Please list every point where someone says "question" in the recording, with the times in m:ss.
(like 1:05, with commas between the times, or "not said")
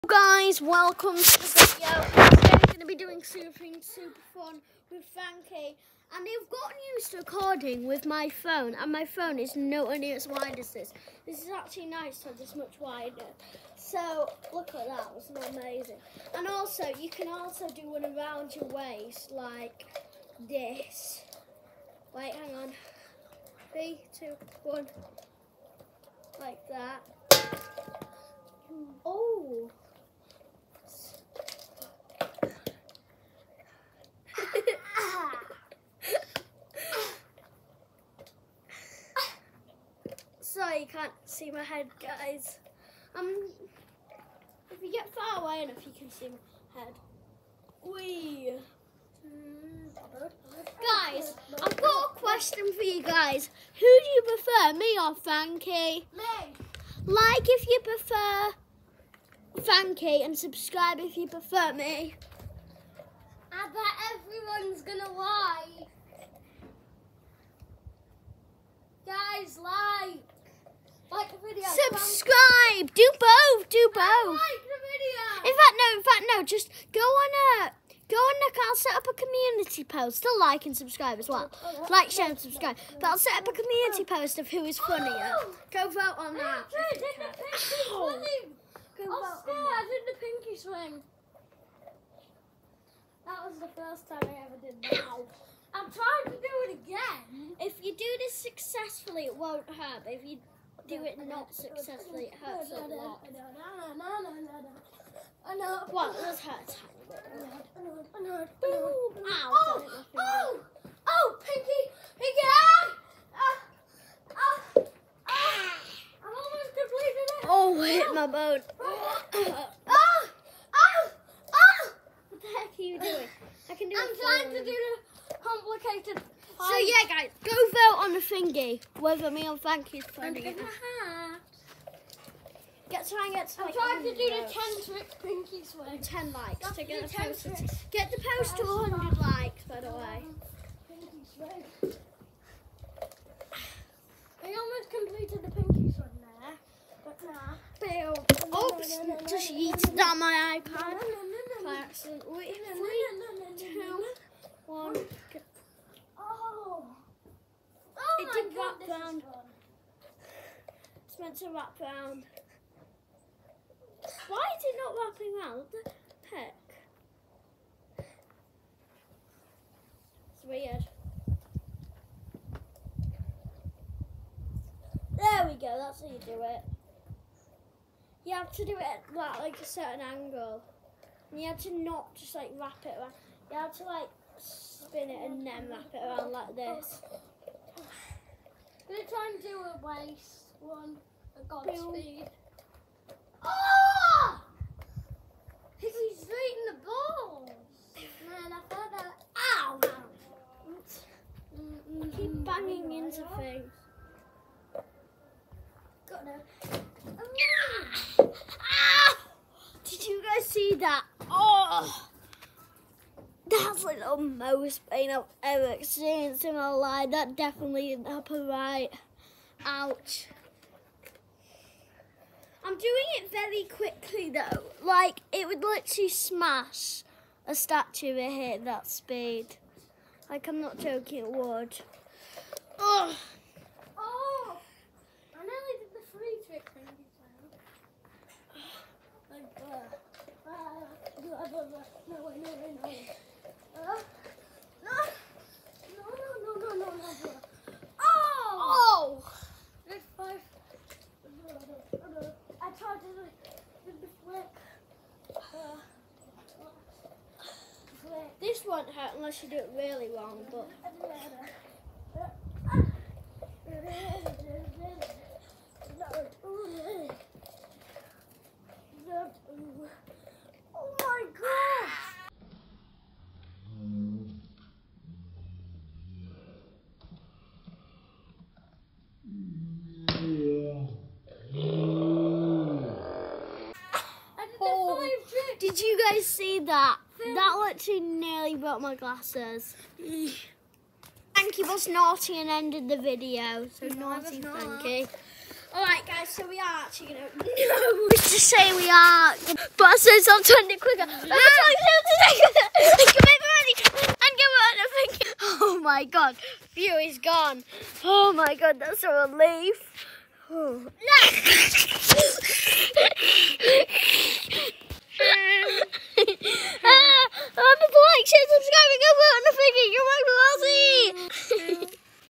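0:52.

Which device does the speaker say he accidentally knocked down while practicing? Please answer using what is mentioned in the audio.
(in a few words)
iPad.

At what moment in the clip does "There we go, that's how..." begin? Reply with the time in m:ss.
2:55.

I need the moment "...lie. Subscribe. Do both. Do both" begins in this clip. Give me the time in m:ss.
1:09.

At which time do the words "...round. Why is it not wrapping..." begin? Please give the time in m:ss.
2:41.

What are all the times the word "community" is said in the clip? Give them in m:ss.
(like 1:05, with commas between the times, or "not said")
1:19, 1:23.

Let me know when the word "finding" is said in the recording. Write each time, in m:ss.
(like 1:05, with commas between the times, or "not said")
2:10.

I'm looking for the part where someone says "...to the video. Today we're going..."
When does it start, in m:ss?
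0:01.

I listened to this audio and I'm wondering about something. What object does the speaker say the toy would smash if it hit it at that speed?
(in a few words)
a statue.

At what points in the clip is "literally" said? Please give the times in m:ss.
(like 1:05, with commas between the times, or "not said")
3:45, 4:47.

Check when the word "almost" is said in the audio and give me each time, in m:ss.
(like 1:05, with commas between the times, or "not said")
1:56, 2:24.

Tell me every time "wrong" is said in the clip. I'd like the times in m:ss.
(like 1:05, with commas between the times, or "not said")
4:20.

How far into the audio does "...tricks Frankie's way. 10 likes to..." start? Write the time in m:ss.
2:14.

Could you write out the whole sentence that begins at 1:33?
That was the first time I ever did that.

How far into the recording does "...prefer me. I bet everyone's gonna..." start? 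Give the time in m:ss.
1:01.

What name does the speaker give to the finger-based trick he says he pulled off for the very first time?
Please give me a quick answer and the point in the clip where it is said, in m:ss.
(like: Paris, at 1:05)
pinky swing, at 1:30.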